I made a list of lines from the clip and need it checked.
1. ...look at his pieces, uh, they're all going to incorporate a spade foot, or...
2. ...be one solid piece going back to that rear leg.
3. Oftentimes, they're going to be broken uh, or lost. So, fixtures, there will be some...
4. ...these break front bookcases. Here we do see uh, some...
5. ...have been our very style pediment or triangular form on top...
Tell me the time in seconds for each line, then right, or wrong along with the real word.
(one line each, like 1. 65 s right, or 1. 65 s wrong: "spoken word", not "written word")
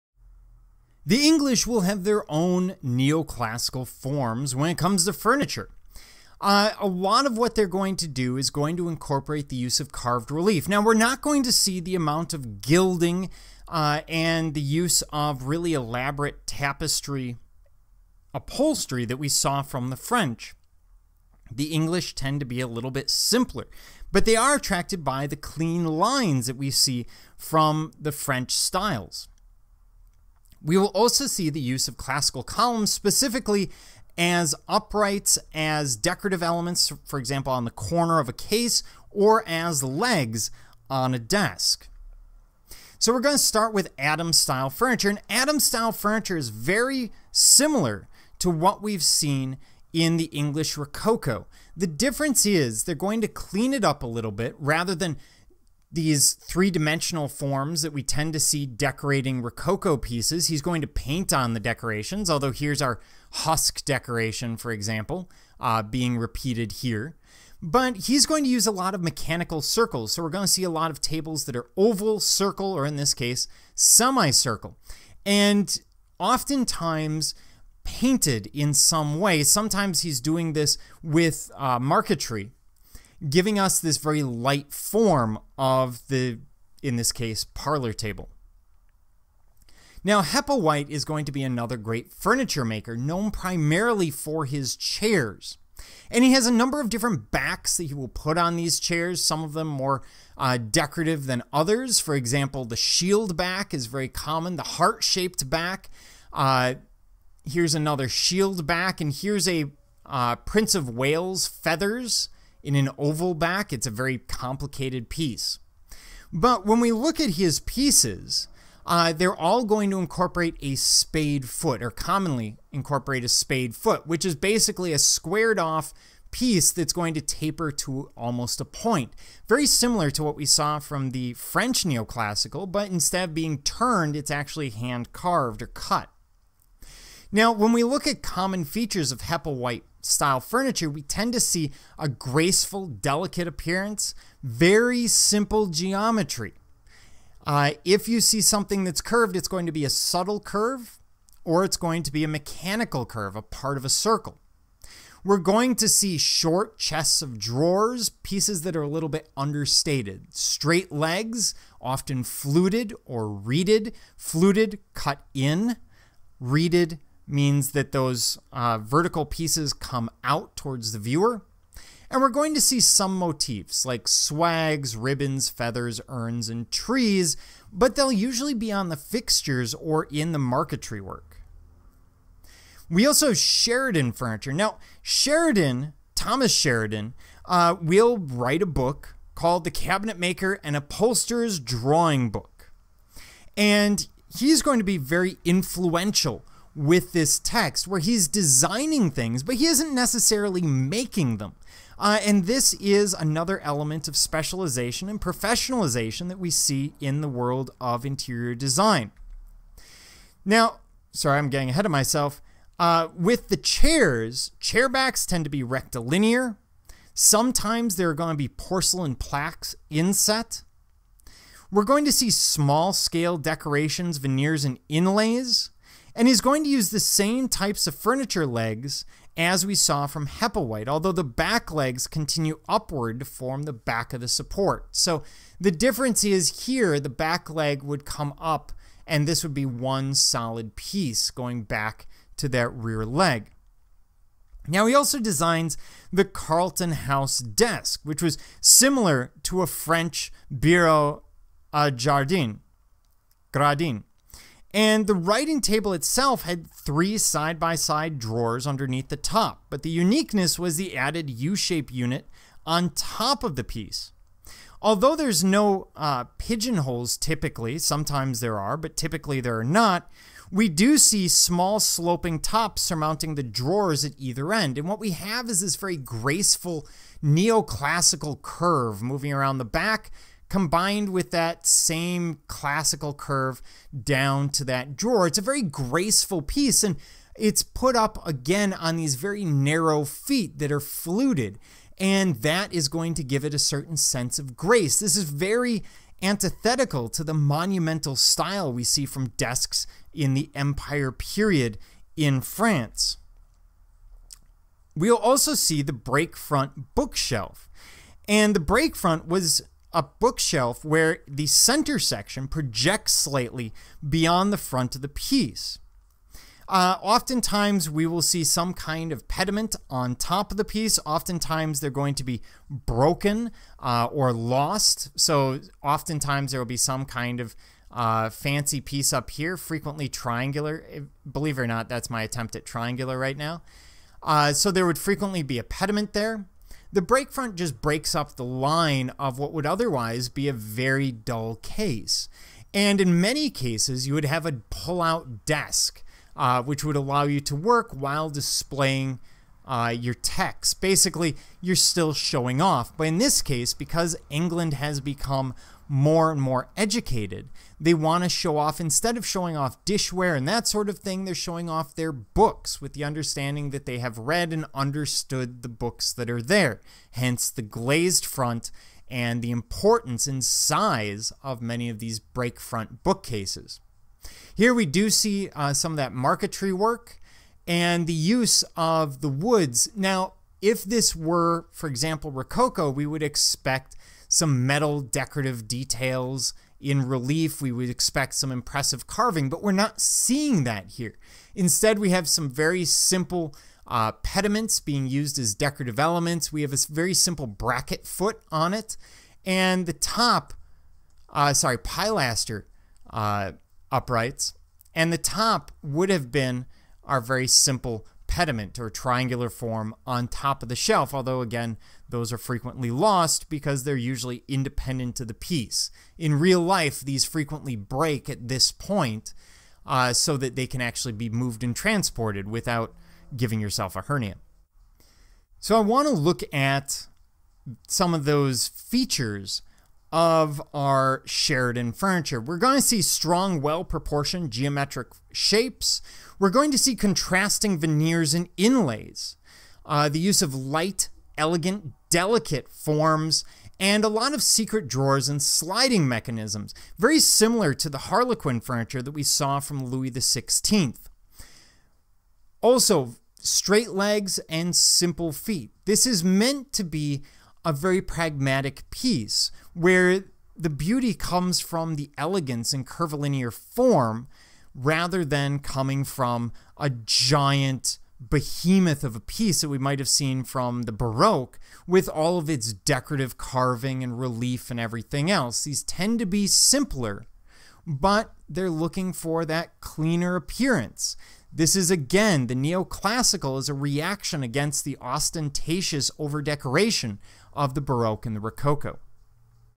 1. 116 s right
2. 239 s right
3. 321 s wrong: "oftentimes", not "fixtures"
4. 371 s right
5. 406 s wrong: "simple", not "style".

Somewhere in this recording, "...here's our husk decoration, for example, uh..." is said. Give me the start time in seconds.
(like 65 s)
62 s.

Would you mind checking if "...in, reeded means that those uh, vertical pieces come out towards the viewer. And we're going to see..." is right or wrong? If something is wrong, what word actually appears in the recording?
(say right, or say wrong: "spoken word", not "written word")
right.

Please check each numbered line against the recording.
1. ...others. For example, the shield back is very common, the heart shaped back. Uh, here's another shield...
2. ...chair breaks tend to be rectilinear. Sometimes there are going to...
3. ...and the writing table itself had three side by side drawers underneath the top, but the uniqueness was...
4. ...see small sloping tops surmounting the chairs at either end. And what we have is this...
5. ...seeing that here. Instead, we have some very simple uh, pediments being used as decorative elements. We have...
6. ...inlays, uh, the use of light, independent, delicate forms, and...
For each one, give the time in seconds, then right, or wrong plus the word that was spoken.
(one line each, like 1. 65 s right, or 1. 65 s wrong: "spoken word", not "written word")
1. 101 s right
2. 214 s wrong: "backs", not "breaks"
3. 254 s right
4. 270 s wrong: "drawers", not "chairs"
5. 389 s right
6. 438 s wrong: "elegant", not "independent".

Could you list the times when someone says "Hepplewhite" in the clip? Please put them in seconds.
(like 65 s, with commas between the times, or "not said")
90 s, 139 s, 230 s.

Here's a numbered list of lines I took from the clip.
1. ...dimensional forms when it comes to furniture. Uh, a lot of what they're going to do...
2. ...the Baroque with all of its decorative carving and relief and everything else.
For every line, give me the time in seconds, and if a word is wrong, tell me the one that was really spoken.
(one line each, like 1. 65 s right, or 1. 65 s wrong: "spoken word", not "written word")
1. 2 s wrong: "neoclassical", not "dimensional"
2. 470 s right.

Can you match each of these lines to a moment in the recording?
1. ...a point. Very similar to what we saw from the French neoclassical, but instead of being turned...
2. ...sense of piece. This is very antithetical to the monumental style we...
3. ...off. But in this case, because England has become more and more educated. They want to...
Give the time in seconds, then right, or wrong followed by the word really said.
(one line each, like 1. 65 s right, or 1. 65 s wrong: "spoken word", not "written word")
1. 128 s right
2. 293 s wrong: "grace", not "piece"
3. 352 s right.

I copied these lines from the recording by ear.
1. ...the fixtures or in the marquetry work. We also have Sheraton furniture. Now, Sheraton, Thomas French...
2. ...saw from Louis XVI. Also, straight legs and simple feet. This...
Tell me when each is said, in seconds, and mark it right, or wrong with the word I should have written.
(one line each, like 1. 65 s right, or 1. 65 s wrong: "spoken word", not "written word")
1. 178 s wrong: "Sheraton", not "French"
2. 449 s right.